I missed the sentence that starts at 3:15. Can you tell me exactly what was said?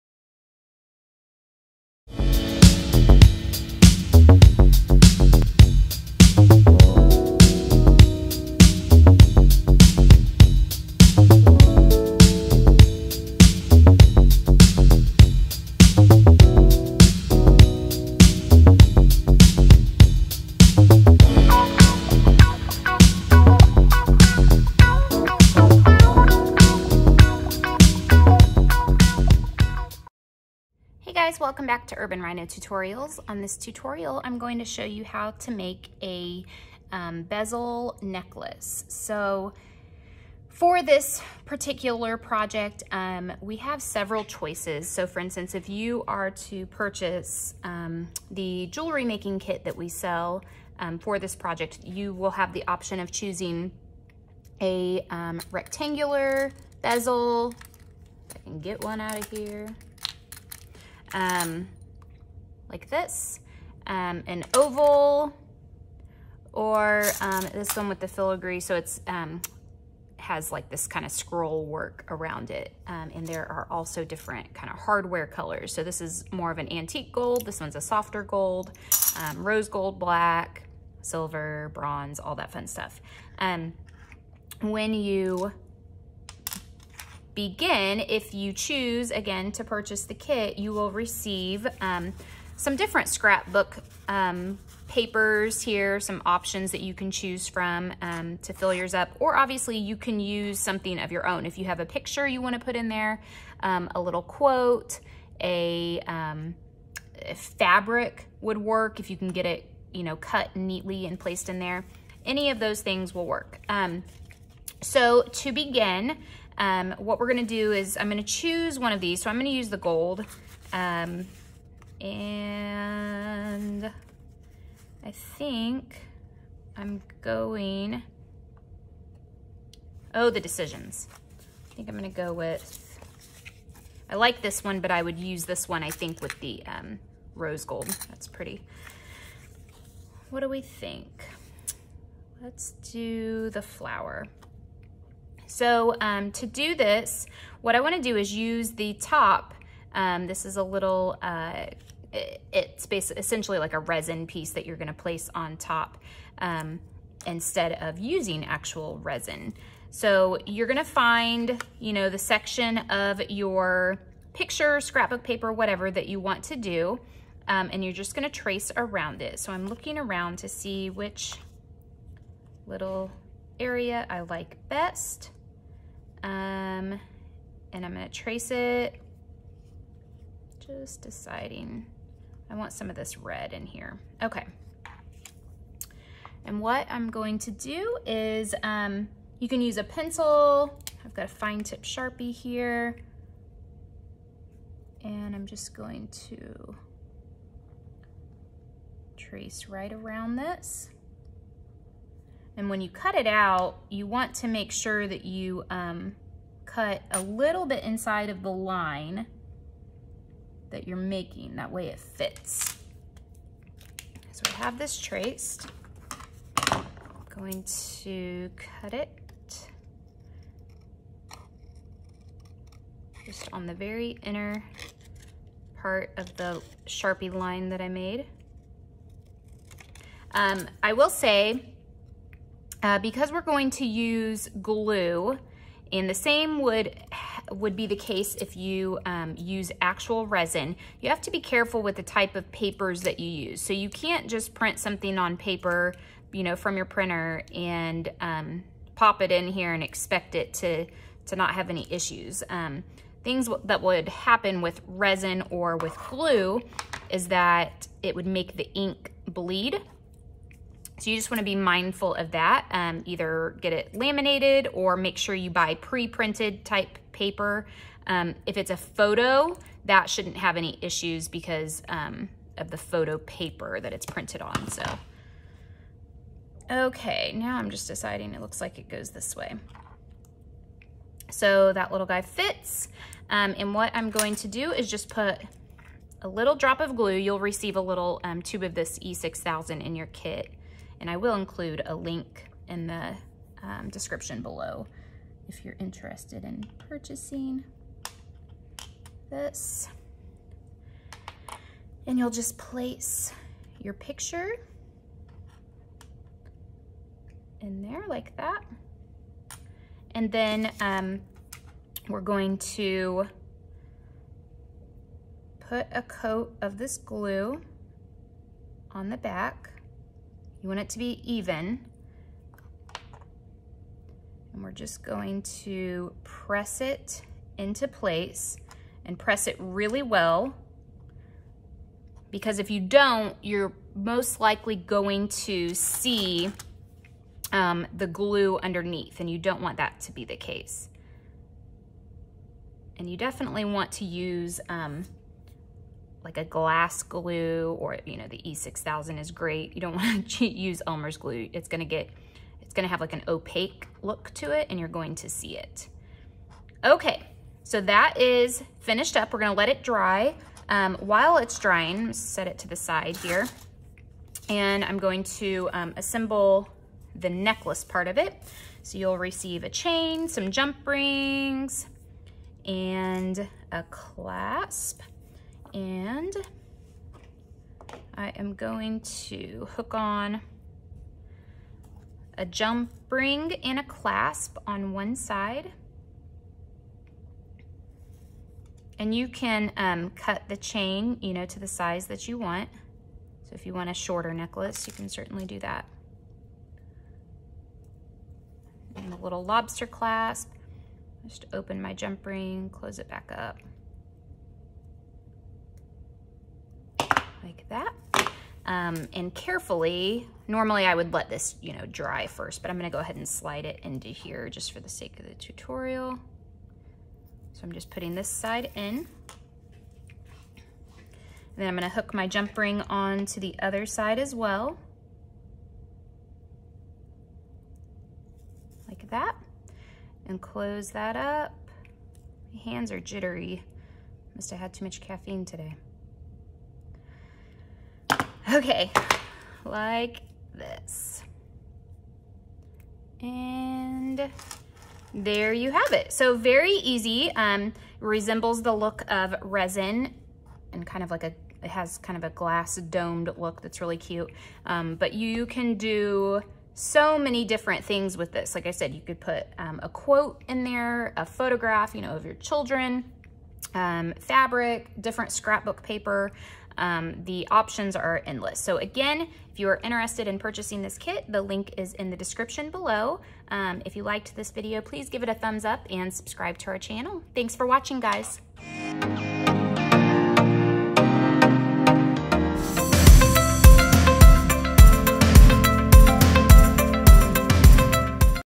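And I'm just going to trace right around this.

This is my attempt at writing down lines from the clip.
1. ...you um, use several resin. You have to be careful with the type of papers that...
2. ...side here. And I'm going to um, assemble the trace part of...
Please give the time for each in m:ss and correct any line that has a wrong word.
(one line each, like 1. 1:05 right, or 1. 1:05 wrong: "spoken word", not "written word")
1. 3:58 wrong: "actual", not "several"
2. 6:02 wrong: "necklace", not "trace".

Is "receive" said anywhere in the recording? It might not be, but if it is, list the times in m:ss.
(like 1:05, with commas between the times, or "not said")
1:30, 4:47, 6:09.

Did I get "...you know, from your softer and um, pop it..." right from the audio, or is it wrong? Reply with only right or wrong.
wrong.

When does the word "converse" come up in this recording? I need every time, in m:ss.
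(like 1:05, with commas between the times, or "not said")
not said.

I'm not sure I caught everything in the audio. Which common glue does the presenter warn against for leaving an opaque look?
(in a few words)
Elmer's glue.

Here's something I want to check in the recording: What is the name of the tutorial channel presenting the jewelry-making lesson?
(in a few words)
Urban Rhino Tutorials.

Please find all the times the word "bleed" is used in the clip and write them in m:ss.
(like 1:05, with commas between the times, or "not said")
4:19.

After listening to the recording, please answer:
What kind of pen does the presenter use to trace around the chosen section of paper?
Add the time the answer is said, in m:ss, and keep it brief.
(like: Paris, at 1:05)
fine tip Sharpie, at 3:11.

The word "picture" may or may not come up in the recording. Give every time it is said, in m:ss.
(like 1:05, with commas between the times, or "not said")
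1:41, 2:44, 5:03.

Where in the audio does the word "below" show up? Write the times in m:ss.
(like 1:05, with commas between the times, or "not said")
4:54, 7:52.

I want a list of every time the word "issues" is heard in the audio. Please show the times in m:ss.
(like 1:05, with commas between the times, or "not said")
4:11, 4:30.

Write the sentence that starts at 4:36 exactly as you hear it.
Okay, now I'm just deciding it looks like it goes this way.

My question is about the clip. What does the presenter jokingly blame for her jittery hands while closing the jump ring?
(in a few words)
caffeine.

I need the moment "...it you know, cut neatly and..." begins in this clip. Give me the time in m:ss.
1:49.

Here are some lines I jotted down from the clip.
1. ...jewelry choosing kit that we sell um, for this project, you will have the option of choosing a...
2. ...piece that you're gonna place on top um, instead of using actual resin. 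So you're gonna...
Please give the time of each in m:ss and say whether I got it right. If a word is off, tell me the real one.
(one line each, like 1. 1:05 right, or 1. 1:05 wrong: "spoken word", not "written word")
1. 0:48 wrong: "making", not "choosing"
2. 2:34 right.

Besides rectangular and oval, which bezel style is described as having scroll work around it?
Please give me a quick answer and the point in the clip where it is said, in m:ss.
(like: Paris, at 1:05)
filigree, at 1:08.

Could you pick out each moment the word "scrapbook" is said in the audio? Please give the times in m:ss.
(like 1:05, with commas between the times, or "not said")
1:33, 2:44, 7:45.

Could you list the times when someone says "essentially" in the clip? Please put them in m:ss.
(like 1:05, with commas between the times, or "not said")
2:33.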